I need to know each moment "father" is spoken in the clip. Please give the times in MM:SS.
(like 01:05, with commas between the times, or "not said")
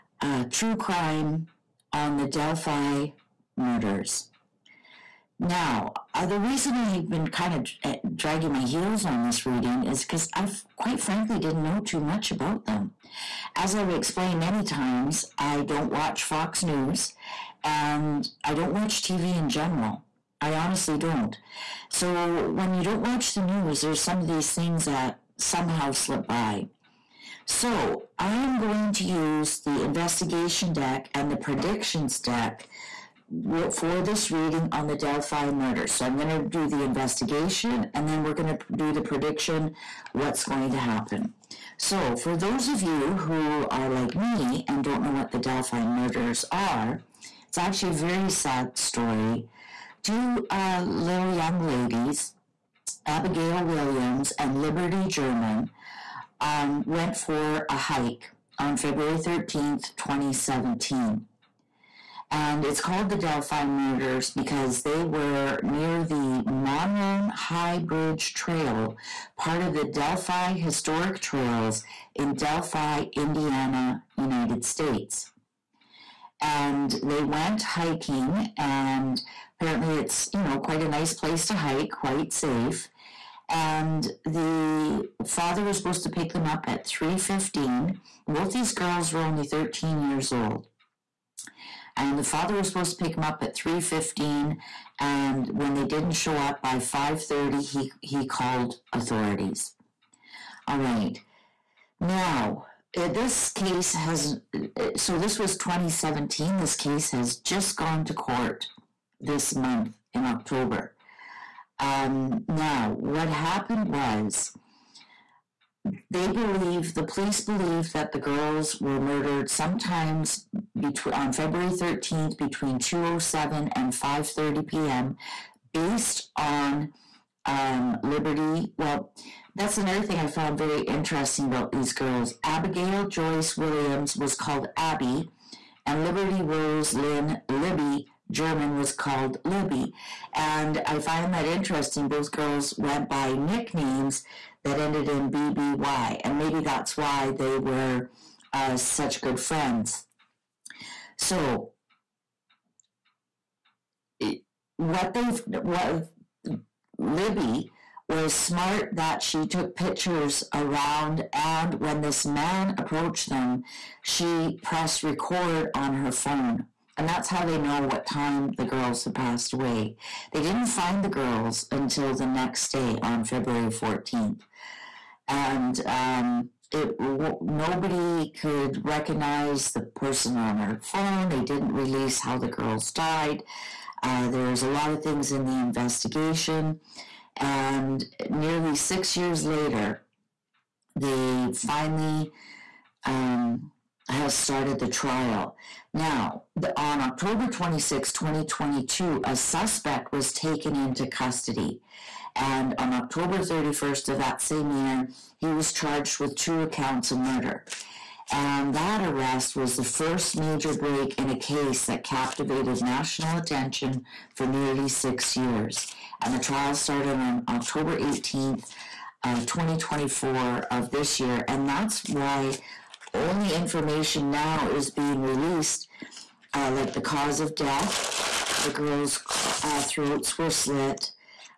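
01:25, 01:32.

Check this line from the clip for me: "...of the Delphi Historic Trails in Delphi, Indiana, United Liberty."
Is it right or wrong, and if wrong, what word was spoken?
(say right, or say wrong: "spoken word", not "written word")
wrong: "States", not "Liberty".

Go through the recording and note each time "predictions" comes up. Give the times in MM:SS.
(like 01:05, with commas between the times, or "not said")
00:31, 00:38.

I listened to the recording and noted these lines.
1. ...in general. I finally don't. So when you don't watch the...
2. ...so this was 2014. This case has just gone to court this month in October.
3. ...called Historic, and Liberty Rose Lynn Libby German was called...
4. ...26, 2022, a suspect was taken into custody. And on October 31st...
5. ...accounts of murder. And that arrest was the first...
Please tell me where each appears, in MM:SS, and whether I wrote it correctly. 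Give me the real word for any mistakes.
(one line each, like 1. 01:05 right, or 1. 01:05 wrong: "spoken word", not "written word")
1. 00:19 wrong: "honestly", not "finally"
2. 01:44 wrong: "2017", not "2014"
3. 02:14 wrong: "Abby", not "Historic"
4. 03:17 right
5. 03:26 right.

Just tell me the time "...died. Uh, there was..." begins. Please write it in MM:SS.
03:02.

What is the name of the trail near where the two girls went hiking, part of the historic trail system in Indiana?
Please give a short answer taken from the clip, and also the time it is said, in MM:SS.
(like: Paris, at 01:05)
Monroe High Bridge Trail, at 01:06.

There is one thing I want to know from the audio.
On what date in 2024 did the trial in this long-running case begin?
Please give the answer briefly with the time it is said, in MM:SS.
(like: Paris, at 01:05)
October 18th, at 03:37.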